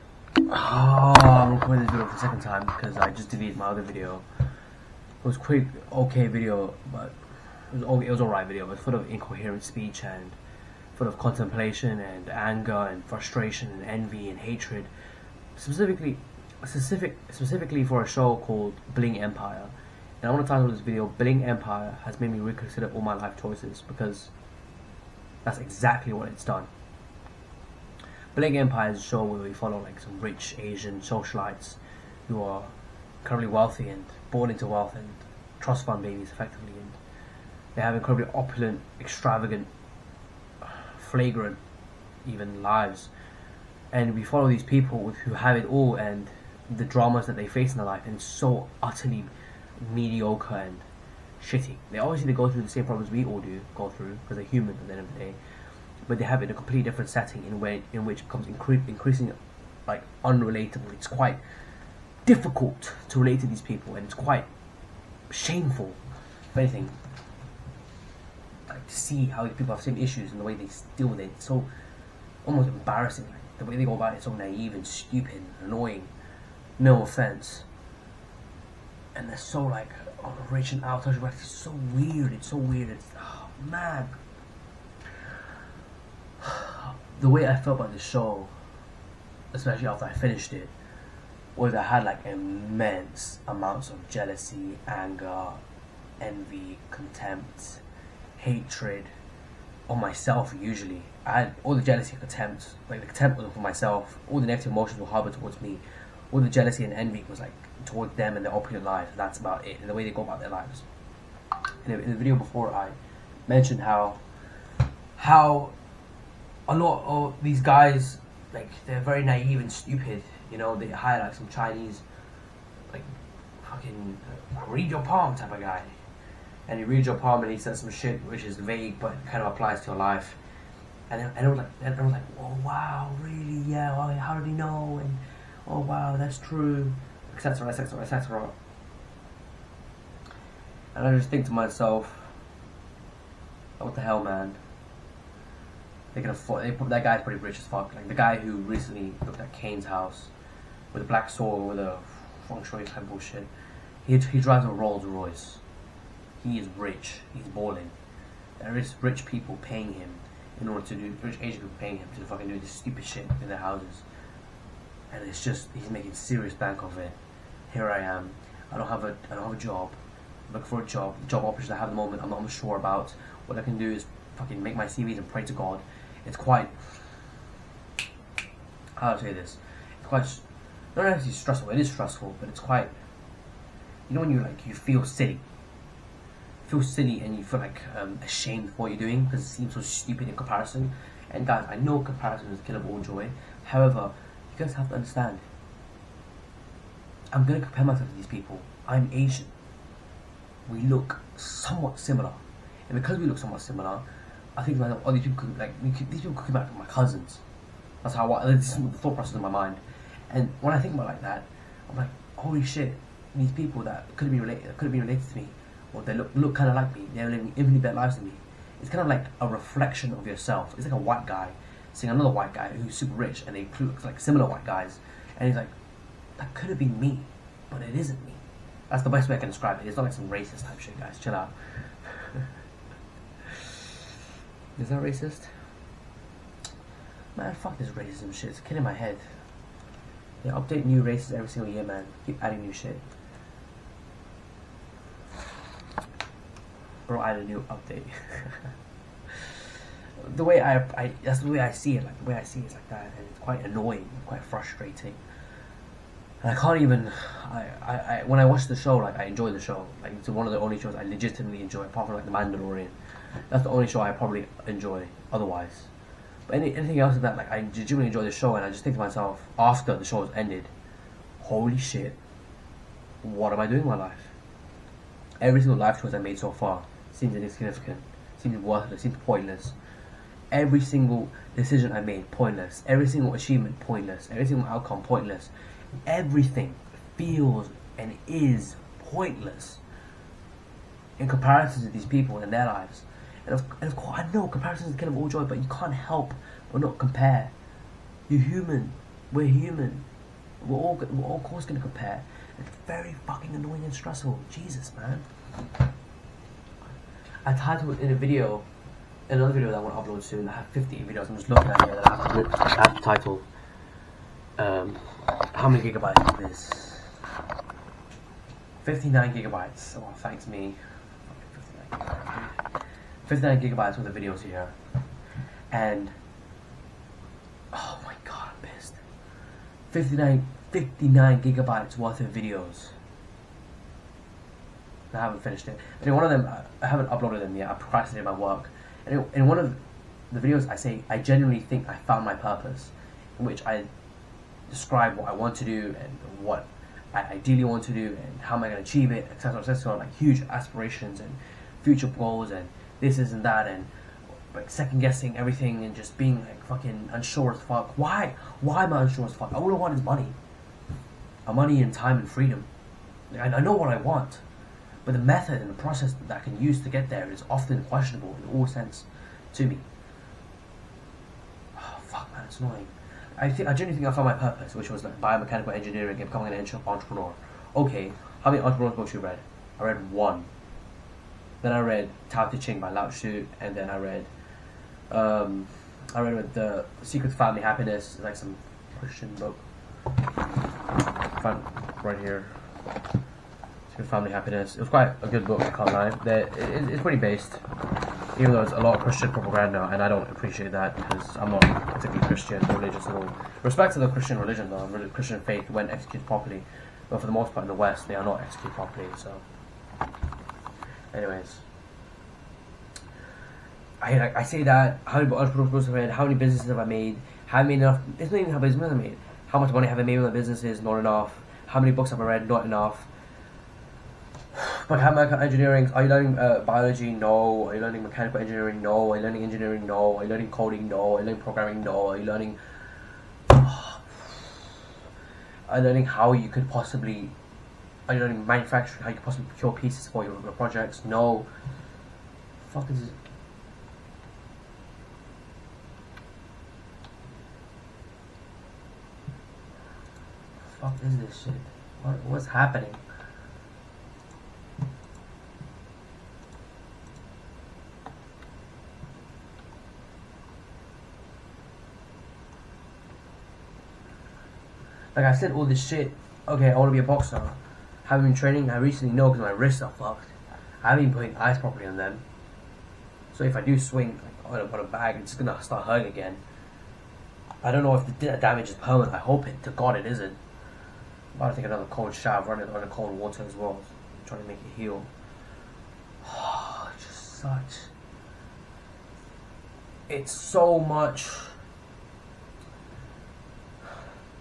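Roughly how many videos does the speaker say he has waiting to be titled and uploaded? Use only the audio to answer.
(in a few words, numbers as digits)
50.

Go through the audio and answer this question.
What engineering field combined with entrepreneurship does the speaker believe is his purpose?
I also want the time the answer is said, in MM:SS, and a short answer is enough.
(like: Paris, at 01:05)
biomechanical engineering, at 06:15.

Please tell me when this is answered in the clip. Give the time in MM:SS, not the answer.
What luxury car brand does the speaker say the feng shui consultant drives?
02:34.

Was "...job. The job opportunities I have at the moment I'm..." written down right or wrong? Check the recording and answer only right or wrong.
right.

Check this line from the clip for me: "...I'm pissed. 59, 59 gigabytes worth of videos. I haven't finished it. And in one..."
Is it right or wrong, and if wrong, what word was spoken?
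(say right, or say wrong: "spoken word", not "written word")
right.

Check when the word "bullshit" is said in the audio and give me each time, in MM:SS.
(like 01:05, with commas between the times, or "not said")
02:33.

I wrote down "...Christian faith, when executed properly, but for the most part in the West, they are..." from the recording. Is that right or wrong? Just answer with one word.
right.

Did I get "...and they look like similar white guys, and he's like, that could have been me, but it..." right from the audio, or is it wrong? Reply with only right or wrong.
right.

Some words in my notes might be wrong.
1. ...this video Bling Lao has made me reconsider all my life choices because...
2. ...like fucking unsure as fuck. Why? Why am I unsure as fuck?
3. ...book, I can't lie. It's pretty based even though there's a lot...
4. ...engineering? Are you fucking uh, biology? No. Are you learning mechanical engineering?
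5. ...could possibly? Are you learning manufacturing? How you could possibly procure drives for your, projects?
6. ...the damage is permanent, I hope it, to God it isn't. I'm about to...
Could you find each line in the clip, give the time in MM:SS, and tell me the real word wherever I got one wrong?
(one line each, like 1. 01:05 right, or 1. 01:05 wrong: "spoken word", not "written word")
1. 00:20 wrong: "Empire", not "Lao"
2. 05:56 right
3. 06:35 right
4. 07:05 wrong: "learning", not "fucking"
5. 07:16 wrong: "pieces", not "drives"
6. 07:58 right.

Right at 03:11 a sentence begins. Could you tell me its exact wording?
And guys, I know comparison is of all joy.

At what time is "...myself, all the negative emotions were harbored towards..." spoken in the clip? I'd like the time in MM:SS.
01:43.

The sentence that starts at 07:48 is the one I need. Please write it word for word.
haven't been training, I recently know because my wrists are fucked.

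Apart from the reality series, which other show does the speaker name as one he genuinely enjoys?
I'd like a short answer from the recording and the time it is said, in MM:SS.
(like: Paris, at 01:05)
The Mandalorian, at 04:22.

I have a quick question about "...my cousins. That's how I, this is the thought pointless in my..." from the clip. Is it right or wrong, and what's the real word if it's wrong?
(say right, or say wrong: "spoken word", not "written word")
wrong: "process", not "pointless".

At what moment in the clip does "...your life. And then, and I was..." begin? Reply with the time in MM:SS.
02:09.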